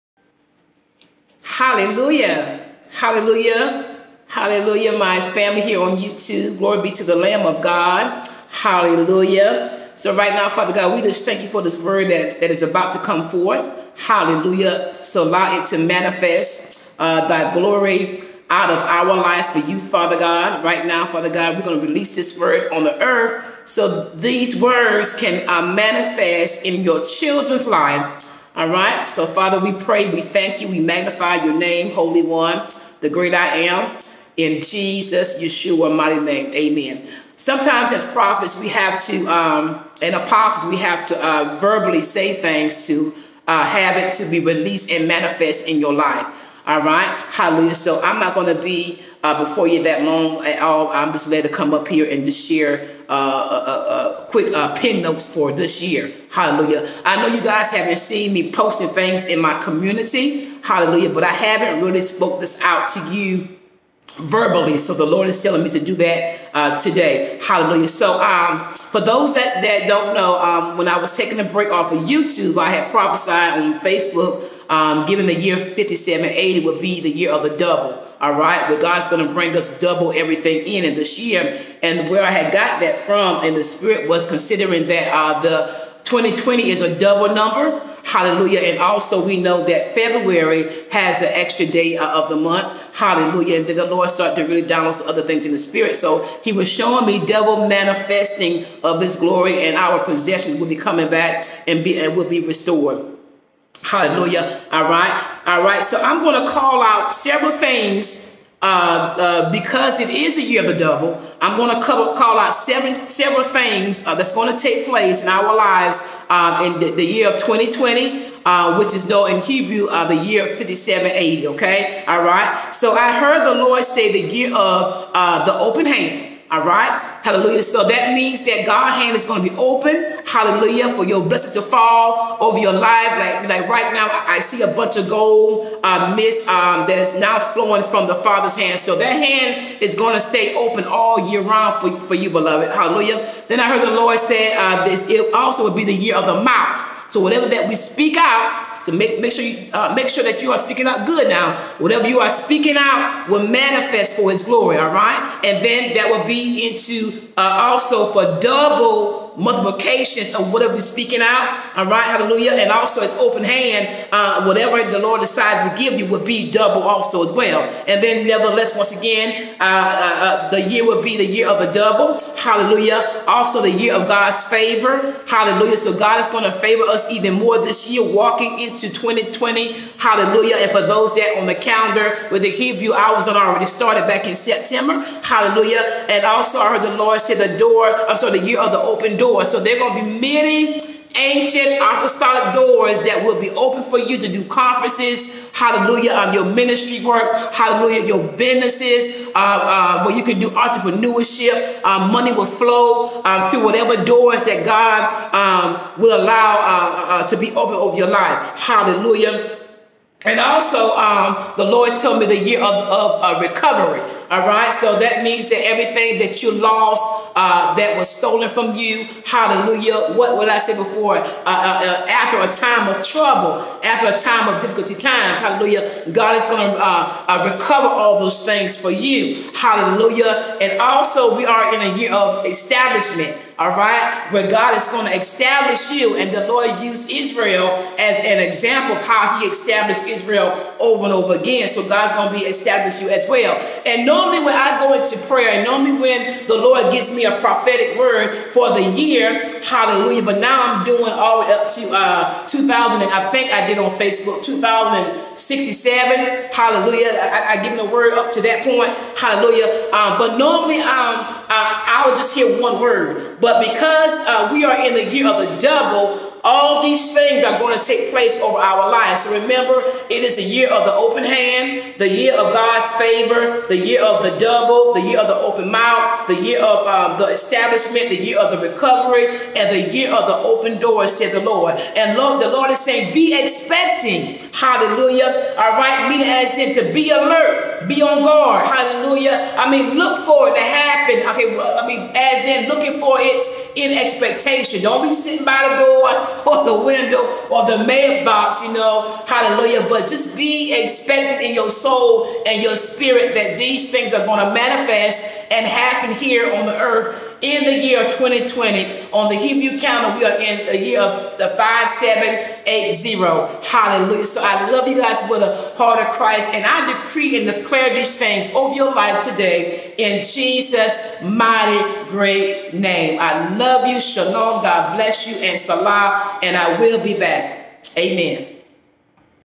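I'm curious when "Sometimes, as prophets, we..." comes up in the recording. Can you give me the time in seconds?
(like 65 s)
37 s.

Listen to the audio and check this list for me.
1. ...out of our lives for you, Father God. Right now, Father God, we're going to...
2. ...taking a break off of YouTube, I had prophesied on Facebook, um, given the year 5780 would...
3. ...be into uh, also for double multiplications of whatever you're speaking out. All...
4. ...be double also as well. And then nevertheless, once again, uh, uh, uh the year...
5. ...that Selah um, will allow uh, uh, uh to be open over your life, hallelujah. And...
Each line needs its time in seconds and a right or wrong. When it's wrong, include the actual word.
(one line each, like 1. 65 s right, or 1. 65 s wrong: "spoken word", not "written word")
1. 18 s right
2. 71 s right
3. 156 s right
4. 166 s right
5. 204 s wrong: "God", not "Selah".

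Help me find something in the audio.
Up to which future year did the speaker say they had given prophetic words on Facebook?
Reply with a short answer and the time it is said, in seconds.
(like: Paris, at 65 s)
2067, at 254 s.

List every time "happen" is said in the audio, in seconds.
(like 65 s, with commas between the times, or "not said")
290 s, 305 s.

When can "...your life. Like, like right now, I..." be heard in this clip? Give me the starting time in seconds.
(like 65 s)
132 s.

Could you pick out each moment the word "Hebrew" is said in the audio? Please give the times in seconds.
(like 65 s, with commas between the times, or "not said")
119 s, 182 s, 309 s.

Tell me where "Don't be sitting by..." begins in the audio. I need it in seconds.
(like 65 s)
294 s.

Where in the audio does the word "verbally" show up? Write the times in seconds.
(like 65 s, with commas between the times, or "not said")
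41 s, 64 s.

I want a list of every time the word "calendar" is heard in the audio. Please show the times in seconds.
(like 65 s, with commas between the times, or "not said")
181 s, 309 s.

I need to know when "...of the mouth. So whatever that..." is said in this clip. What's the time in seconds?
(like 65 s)
146 s.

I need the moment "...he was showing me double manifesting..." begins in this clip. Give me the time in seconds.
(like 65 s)
96 s.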